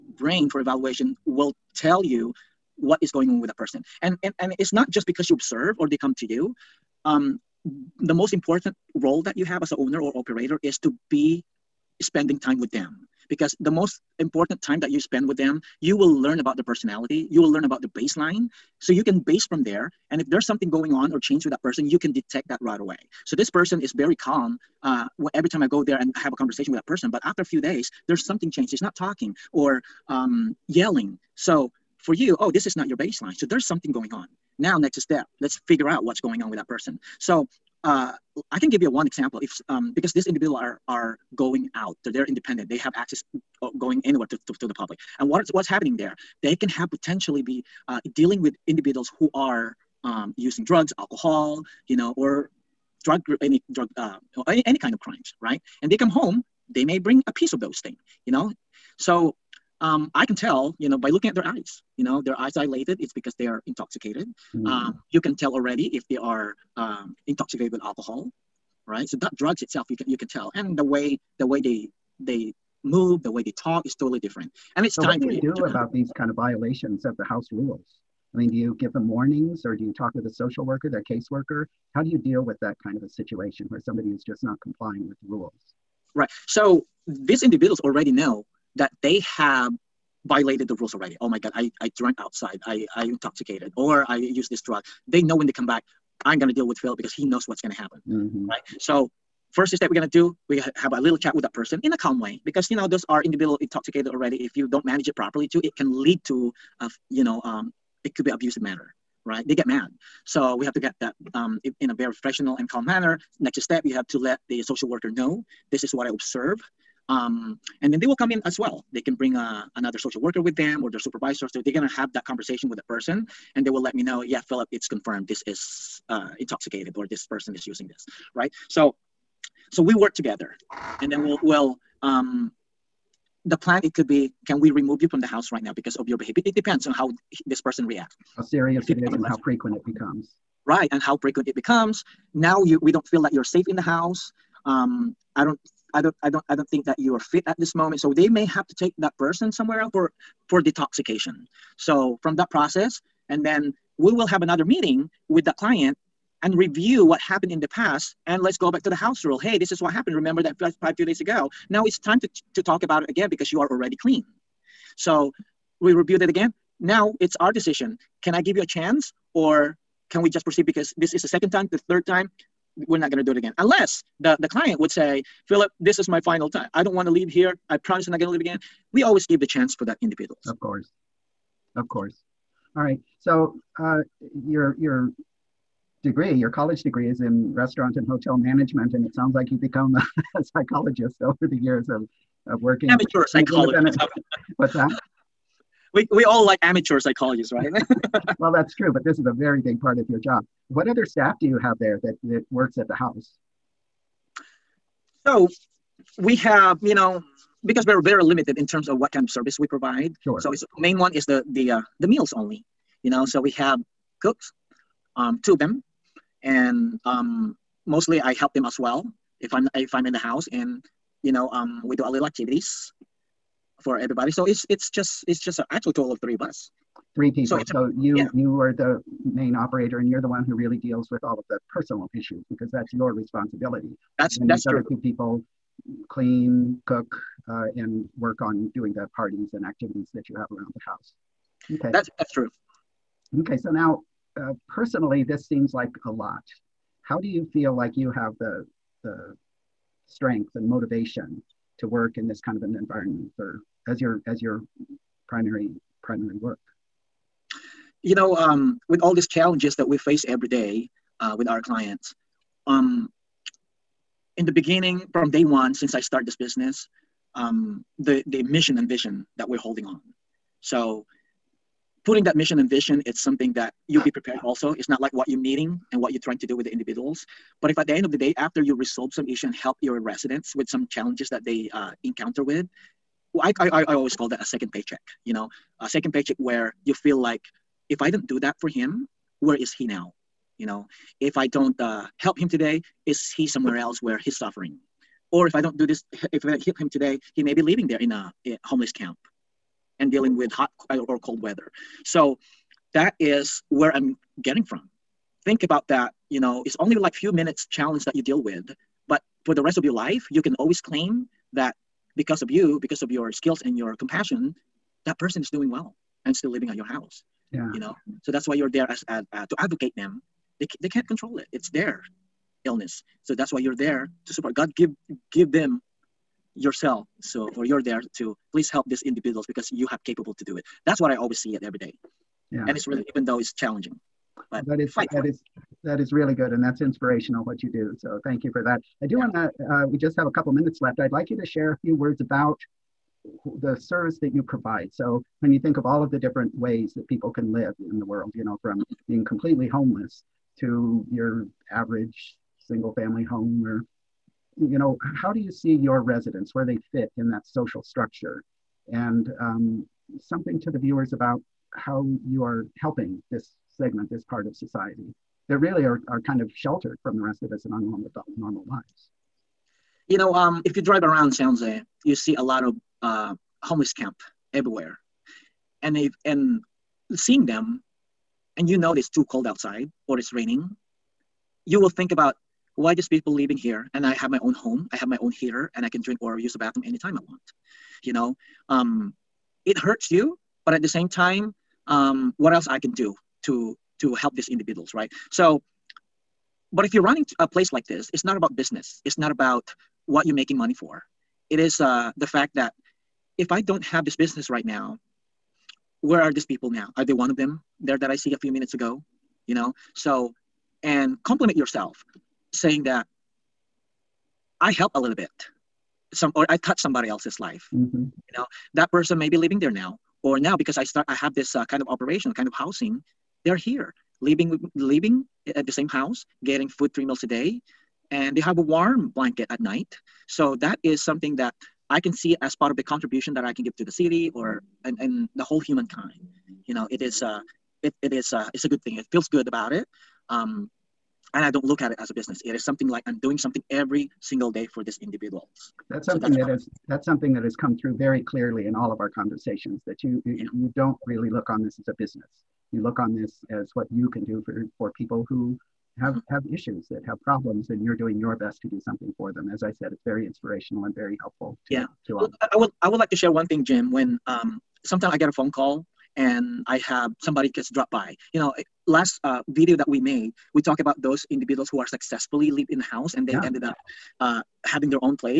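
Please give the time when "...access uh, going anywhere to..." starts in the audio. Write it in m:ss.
0:42.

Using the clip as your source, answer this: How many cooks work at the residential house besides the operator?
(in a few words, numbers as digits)
2.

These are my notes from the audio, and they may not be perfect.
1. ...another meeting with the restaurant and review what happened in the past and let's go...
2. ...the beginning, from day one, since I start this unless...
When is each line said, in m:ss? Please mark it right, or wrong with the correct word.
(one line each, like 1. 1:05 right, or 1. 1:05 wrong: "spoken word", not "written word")
1. 2:34 wrong: "client", not "restaurant"
2. 4:24 wrong: "business", not "unless".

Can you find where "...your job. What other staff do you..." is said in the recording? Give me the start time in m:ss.
3:20.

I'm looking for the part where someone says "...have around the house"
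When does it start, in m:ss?
4:00.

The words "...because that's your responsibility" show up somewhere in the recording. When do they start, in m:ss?
3:52.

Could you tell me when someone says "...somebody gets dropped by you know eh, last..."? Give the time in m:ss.
7:47.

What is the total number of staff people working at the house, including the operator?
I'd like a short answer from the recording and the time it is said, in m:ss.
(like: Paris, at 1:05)
3, at 3:46.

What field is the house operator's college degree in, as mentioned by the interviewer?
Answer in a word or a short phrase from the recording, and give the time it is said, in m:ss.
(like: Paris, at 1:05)
Restaurant and hotel management, at 3:07.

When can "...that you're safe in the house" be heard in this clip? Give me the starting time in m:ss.
2:23.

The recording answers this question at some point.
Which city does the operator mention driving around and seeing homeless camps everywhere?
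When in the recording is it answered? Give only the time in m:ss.
6:11.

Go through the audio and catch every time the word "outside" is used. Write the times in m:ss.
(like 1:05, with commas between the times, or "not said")
1:32, 6:19.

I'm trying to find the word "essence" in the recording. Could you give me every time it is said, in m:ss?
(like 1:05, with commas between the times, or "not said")
not said.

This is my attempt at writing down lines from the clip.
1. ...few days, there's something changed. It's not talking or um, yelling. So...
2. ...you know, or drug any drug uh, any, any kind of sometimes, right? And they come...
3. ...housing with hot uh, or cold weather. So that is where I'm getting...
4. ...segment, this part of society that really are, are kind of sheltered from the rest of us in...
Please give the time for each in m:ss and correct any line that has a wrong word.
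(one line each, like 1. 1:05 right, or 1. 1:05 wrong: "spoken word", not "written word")
1. 0:27 right
2. 0:51 wrong: "crimes", not "sometimes"
3. 5:00 wrong: "dealing", not "housing"
4. 6:03 right.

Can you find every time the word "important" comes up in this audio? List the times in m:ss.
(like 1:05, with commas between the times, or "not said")
0:08, 0:14.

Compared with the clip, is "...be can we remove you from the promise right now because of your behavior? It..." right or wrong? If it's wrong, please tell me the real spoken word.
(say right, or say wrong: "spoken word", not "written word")
wrong: "house", not "promise".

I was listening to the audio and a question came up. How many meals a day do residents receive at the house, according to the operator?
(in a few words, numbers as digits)
3.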